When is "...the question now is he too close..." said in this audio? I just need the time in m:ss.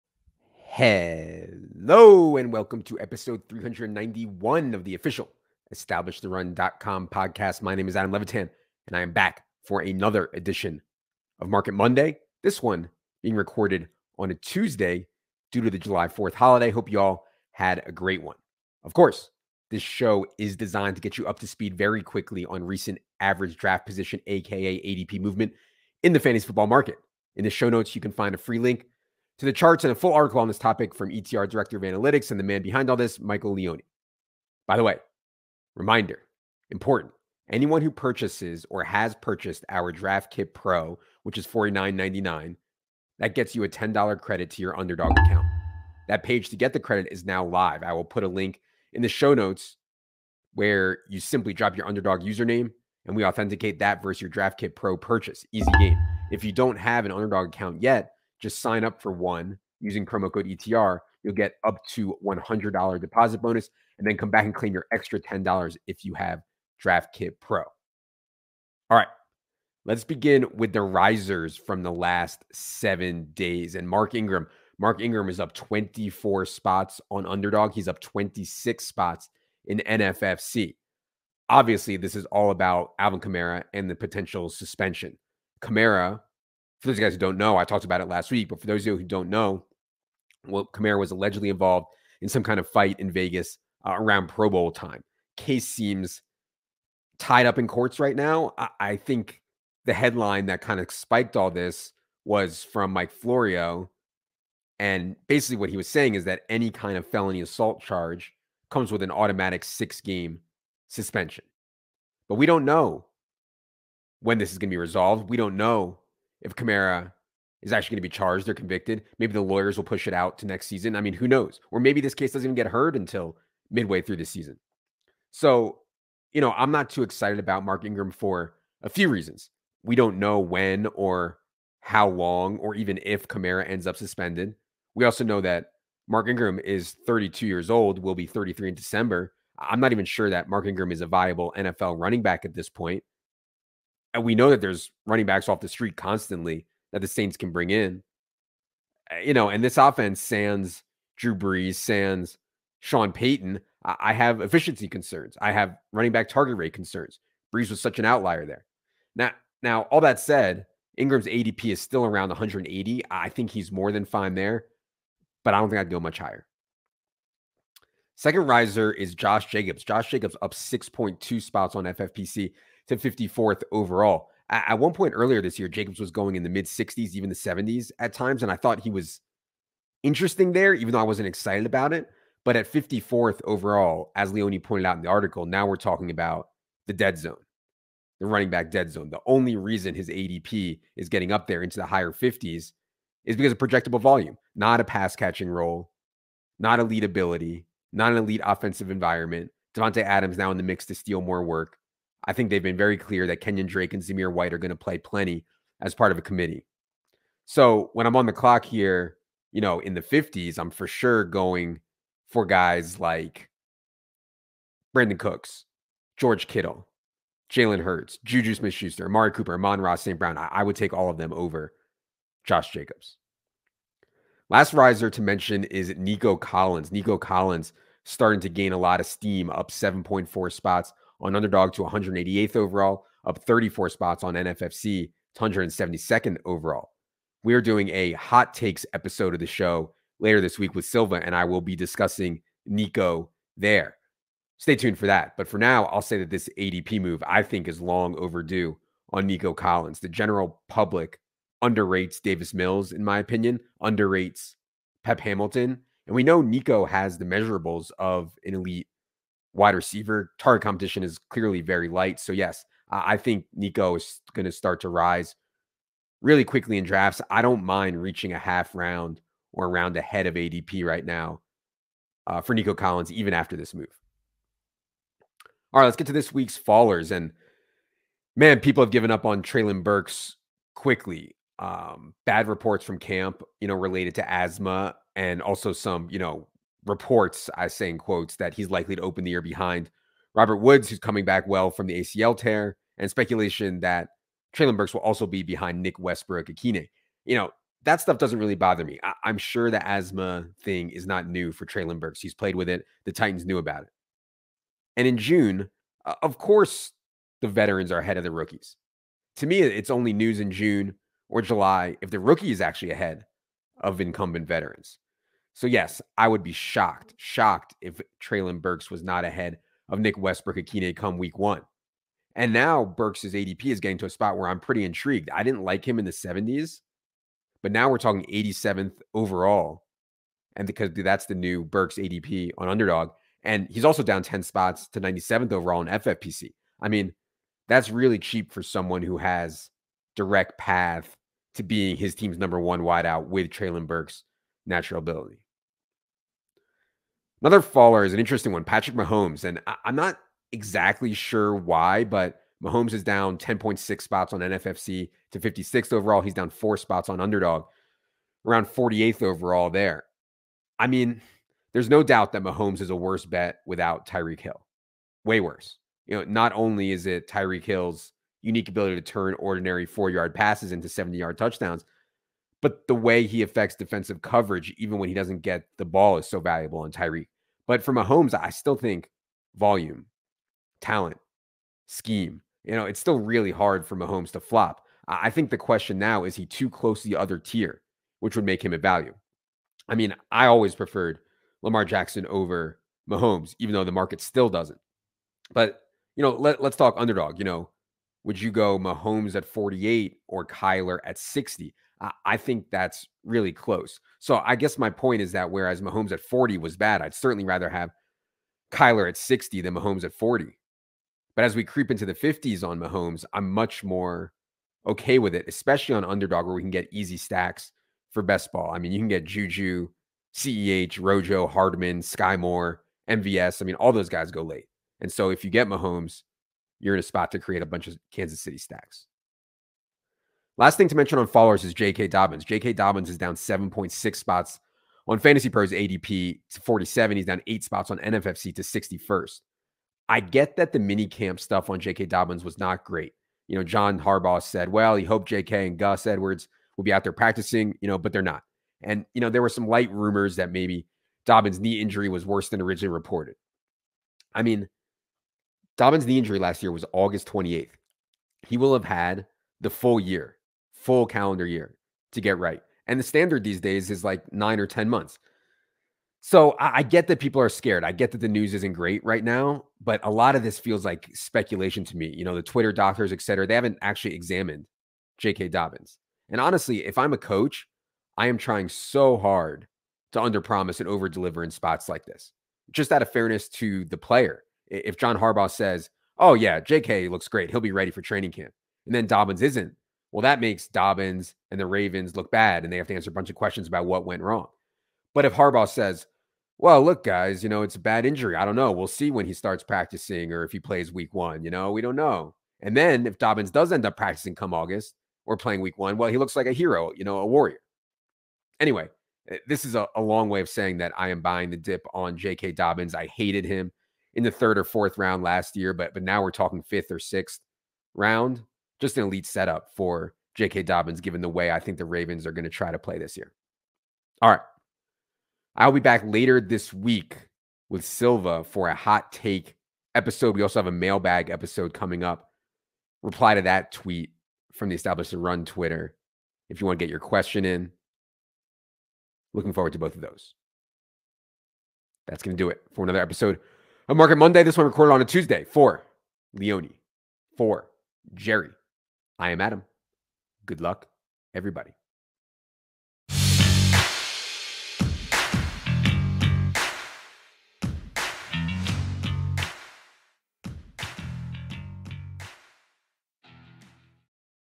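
6:25.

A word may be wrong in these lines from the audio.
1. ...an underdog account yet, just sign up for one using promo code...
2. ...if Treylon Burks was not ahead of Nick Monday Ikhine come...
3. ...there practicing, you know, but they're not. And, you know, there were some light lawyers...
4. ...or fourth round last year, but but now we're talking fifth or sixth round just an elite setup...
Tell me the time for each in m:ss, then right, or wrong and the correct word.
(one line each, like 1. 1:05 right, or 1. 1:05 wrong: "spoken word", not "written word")
1. 0:57 right
2. 5:17 wrong: "Westbrook", not "Monday"
3. 7:27 wrong: "rumors", not "lawyers"
4. 8:34 right.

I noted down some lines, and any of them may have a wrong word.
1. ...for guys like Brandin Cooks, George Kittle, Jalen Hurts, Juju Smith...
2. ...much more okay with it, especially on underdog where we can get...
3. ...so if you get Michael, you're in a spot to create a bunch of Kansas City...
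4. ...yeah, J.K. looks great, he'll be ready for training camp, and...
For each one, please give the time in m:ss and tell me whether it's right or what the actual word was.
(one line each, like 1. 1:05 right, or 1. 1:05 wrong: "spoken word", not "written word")
1. 3:32 right
2. 6:53 right
3. 7:05 wrong: "Mahomes", not "Michael"
4. 8:06 right.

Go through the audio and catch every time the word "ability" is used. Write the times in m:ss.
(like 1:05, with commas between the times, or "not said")
3:17, 5:44, 6:08.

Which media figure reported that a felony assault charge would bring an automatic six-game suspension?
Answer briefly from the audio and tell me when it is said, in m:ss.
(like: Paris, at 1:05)
Mike Florio, at 1:42.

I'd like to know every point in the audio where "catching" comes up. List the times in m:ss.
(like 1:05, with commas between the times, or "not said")
3:15.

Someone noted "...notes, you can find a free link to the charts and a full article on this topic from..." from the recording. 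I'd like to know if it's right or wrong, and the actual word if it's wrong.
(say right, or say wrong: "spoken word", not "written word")
right.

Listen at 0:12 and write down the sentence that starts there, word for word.
This one being recorded on a Tuesday due to the July 4th holiday.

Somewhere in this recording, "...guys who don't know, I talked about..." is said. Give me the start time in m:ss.
1:26.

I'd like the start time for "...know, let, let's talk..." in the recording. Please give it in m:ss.
6:36.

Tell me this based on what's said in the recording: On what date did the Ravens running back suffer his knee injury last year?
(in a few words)
August 28th.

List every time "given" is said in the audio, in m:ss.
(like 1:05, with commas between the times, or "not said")
4:38, 8:40.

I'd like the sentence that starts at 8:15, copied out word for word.
But if Harbaugh says, well, look, guys, you know, it's a bad injury.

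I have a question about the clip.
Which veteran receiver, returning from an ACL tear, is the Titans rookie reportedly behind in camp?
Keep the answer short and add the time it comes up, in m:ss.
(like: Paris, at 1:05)
Robert Woods, at 4:50.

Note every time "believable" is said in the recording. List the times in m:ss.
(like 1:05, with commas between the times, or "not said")
not said.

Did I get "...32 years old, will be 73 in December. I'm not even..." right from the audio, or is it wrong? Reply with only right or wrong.
wrong.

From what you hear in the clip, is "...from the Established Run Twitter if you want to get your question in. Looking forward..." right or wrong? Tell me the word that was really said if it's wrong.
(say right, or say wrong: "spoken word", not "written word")
right.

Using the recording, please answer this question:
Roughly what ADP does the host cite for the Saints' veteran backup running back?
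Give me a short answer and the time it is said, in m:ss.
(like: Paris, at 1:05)
180, at 2:42.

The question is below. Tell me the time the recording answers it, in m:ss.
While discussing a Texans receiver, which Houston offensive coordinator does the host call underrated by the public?
4:15.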